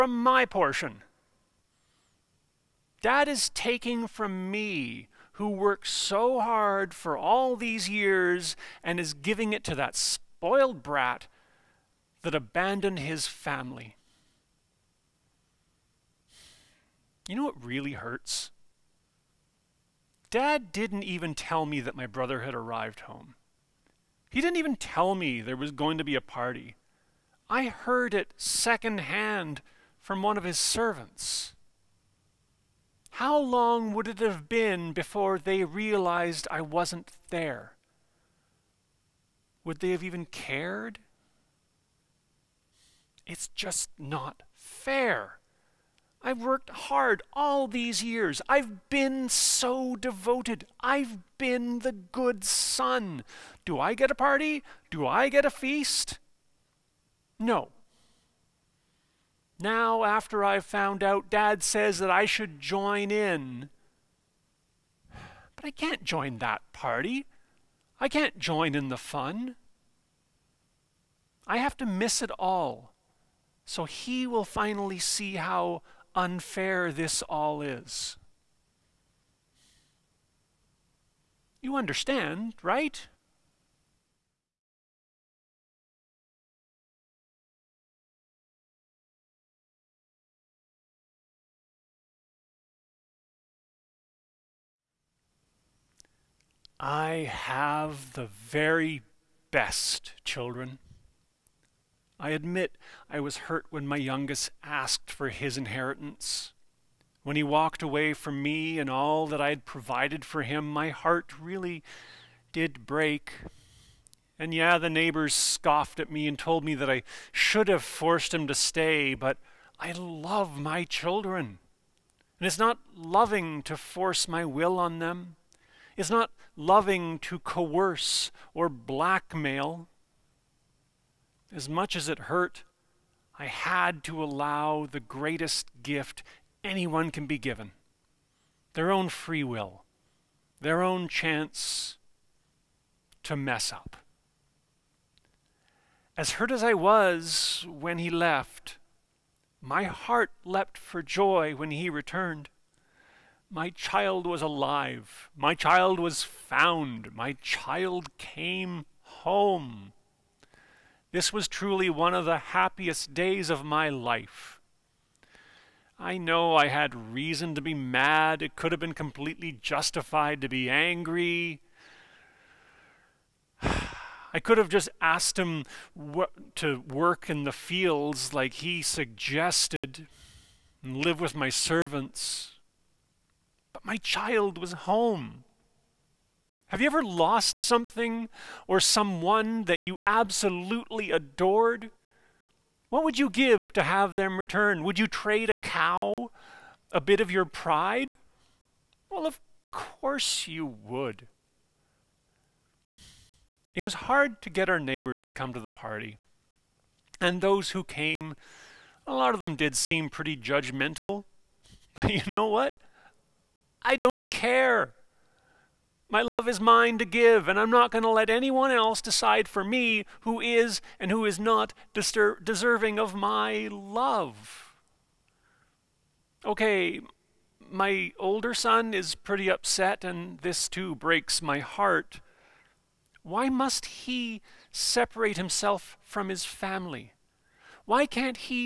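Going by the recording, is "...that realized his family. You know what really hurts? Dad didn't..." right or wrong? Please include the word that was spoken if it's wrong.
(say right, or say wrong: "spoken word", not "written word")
wrong: "abandoned", not "realized".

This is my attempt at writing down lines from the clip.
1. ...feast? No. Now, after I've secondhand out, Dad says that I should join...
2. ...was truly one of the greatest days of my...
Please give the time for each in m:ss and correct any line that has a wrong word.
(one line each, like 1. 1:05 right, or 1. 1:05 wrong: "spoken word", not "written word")
1. 0:55 wrong: "found", not "secondhand"
2. 2:41 wrong: "happiest", not "greatest".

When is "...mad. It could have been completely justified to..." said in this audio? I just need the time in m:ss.
2:47.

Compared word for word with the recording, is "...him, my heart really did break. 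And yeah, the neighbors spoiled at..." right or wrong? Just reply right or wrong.
wrong.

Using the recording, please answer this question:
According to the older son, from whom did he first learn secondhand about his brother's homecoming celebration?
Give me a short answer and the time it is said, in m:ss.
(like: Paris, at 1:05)
One of his servants, at 0:30.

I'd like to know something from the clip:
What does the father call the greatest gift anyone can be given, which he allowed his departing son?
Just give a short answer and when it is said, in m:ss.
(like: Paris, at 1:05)
Free will, at 2:19.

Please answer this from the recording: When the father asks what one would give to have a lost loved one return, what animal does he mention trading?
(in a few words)
A cow.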